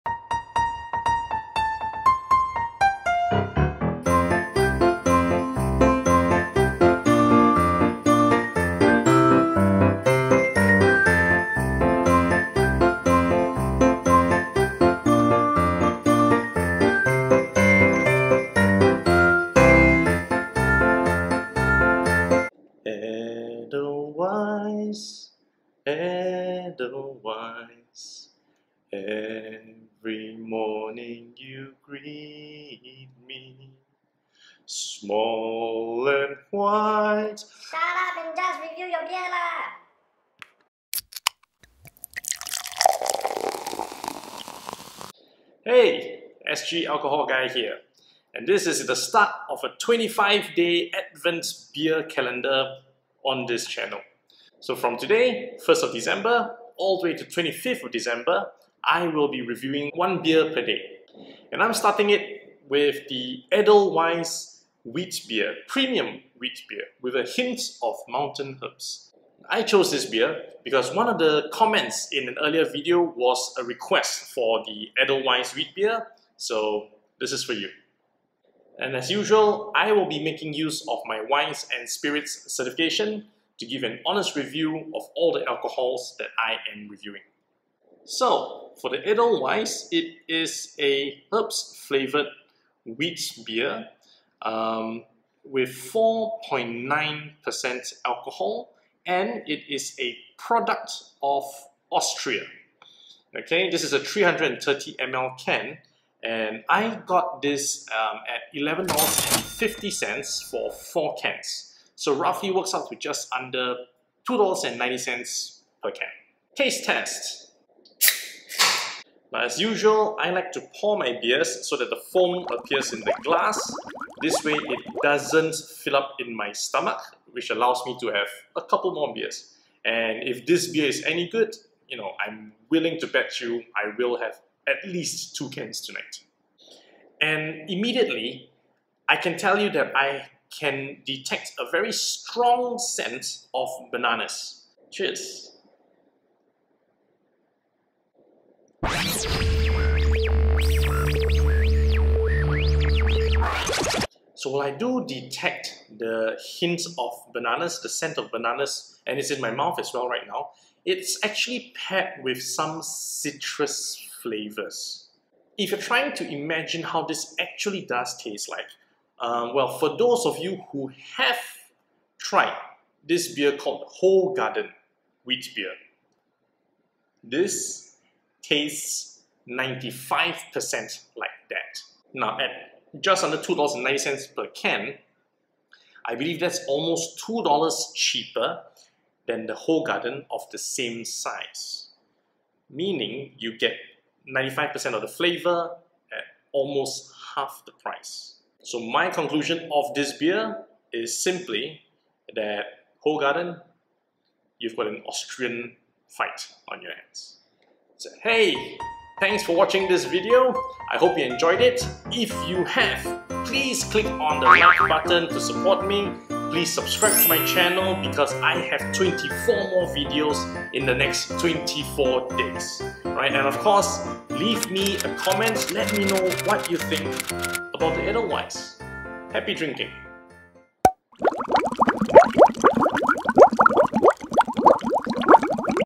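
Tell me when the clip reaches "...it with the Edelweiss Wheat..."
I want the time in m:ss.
1:02.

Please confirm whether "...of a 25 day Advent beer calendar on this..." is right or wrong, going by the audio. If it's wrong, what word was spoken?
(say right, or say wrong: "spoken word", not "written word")
right.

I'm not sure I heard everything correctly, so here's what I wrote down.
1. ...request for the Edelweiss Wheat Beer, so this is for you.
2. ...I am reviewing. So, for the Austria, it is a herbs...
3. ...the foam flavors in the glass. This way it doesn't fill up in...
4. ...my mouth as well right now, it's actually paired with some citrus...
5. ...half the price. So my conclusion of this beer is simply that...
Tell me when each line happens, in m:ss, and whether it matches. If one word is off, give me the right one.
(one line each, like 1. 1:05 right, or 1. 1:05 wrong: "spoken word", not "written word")
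1. 1:13 right
2. 1:26 wrong: "Edelweiss", not "Austria"
3. 2:01 wrong: "appears", not "flavors"
4. 2:39 right
5. 3:17 right.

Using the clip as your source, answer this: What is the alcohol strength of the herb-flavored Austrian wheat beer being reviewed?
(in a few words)
4.9%.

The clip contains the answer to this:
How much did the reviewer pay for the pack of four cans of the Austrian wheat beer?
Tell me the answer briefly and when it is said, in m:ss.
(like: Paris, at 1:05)
$11.50, at 1:48.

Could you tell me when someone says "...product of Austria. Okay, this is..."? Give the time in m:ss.
1:40.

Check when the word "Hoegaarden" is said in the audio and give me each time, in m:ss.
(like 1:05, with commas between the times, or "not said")
2:54, 3:09, 3:23.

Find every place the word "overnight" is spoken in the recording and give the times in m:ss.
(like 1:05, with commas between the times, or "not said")
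not said.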